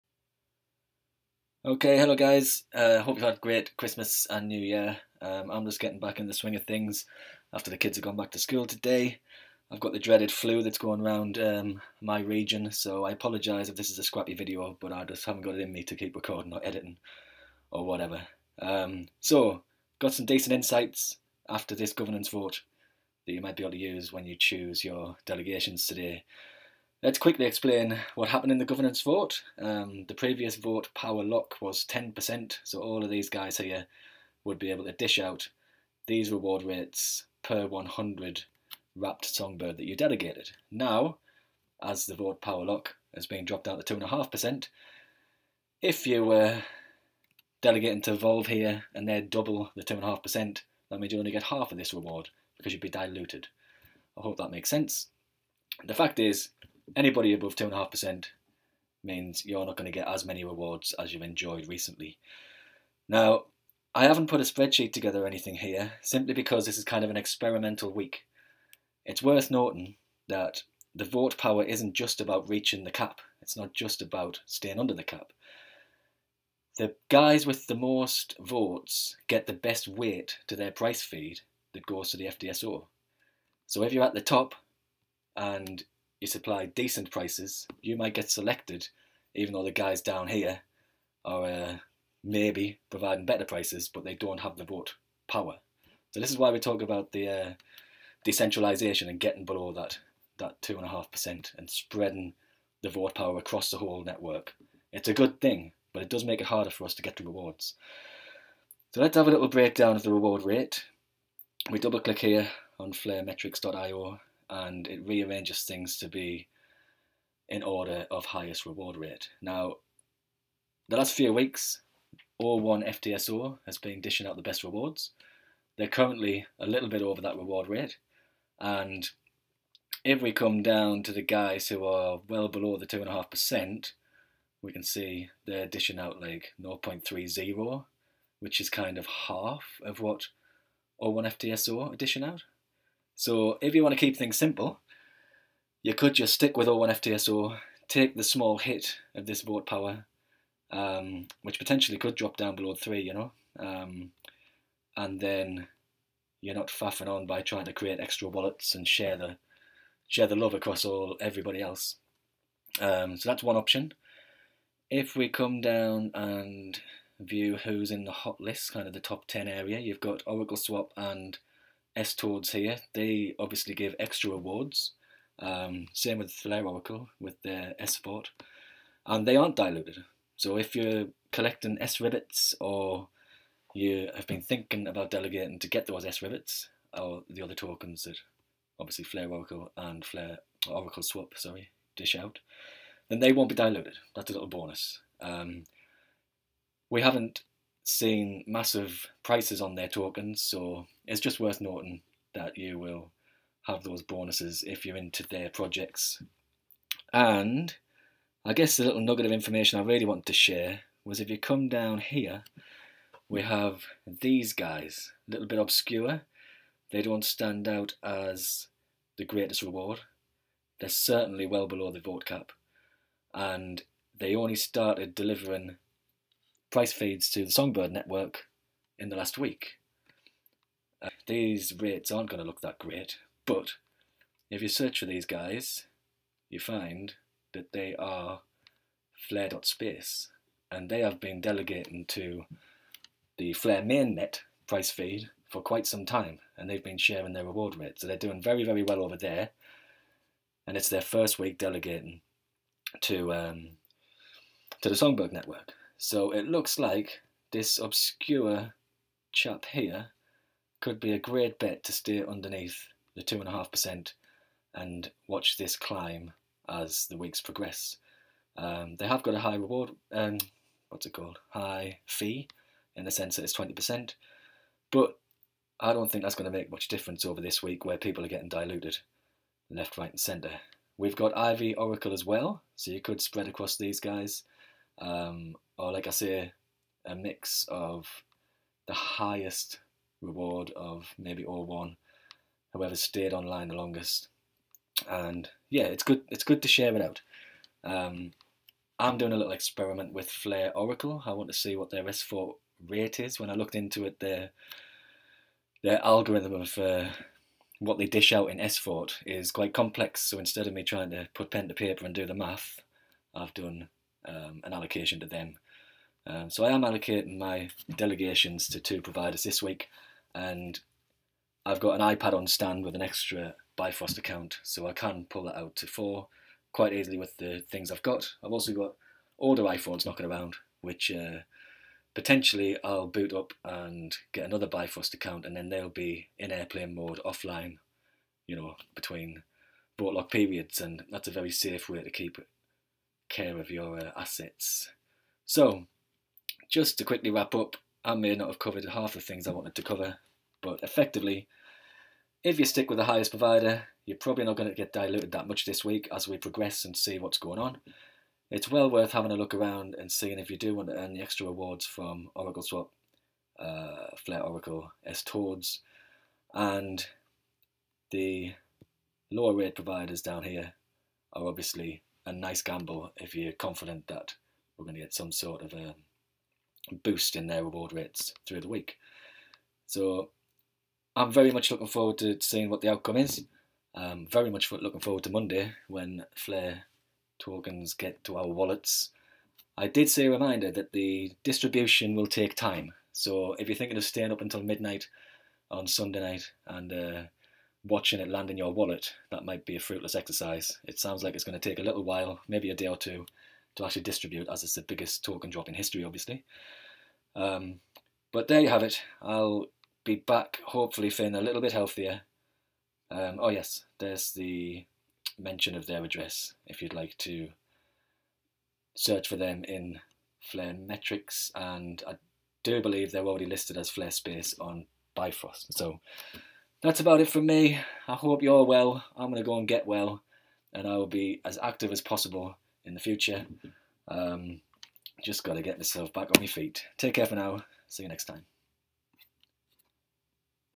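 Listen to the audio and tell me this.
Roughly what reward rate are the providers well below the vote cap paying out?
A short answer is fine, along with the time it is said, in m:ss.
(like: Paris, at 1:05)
0.30, at 2:16.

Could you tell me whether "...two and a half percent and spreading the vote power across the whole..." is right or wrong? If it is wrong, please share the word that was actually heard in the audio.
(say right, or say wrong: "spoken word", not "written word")
right.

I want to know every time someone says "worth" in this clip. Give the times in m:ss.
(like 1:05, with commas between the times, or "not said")
1:09, 3:21, 5:58.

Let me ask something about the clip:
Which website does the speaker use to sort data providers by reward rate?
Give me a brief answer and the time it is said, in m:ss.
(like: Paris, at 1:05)
flaremetrics.io, at 1:52.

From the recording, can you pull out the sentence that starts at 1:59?
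Now, the last few weeks, O1 FTSO has been dishing out the best rewards.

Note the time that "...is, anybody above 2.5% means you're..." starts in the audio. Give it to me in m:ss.
0:56.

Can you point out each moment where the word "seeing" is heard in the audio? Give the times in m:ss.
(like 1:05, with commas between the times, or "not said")
6:00, 6:22.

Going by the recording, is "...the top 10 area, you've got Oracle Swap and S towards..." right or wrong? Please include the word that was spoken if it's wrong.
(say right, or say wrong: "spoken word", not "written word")
right.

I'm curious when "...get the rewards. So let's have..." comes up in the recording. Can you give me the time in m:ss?
1:47.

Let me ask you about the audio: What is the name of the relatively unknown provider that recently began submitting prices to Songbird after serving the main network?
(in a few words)
flare.space.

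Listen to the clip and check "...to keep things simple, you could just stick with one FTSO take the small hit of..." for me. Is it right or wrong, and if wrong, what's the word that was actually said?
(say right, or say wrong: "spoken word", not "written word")
right.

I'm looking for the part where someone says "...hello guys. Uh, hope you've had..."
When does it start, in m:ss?
0:01.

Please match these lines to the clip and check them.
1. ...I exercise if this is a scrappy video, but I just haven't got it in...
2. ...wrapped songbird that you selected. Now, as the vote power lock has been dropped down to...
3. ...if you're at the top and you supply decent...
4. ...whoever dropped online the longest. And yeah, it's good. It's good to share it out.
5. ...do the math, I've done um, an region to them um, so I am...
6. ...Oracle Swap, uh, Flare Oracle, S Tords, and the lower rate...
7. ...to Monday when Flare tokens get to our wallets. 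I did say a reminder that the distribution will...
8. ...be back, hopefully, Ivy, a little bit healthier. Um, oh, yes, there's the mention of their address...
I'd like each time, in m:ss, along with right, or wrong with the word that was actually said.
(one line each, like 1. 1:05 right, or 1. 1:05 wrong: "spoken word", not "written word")
1. 0:13 wrong: "apologise", not "exercise"
2. 0:38 wrong: "delegated", not "selected"
3. 1:23 right
4. 4:52 wrong: "stayed", not "dropped"
5. 5:12 wrong: "allocation", not "region"
6. 6:02 right
7. 6:25 right
8. 6:50 wrong: "Finn", not "Ivy".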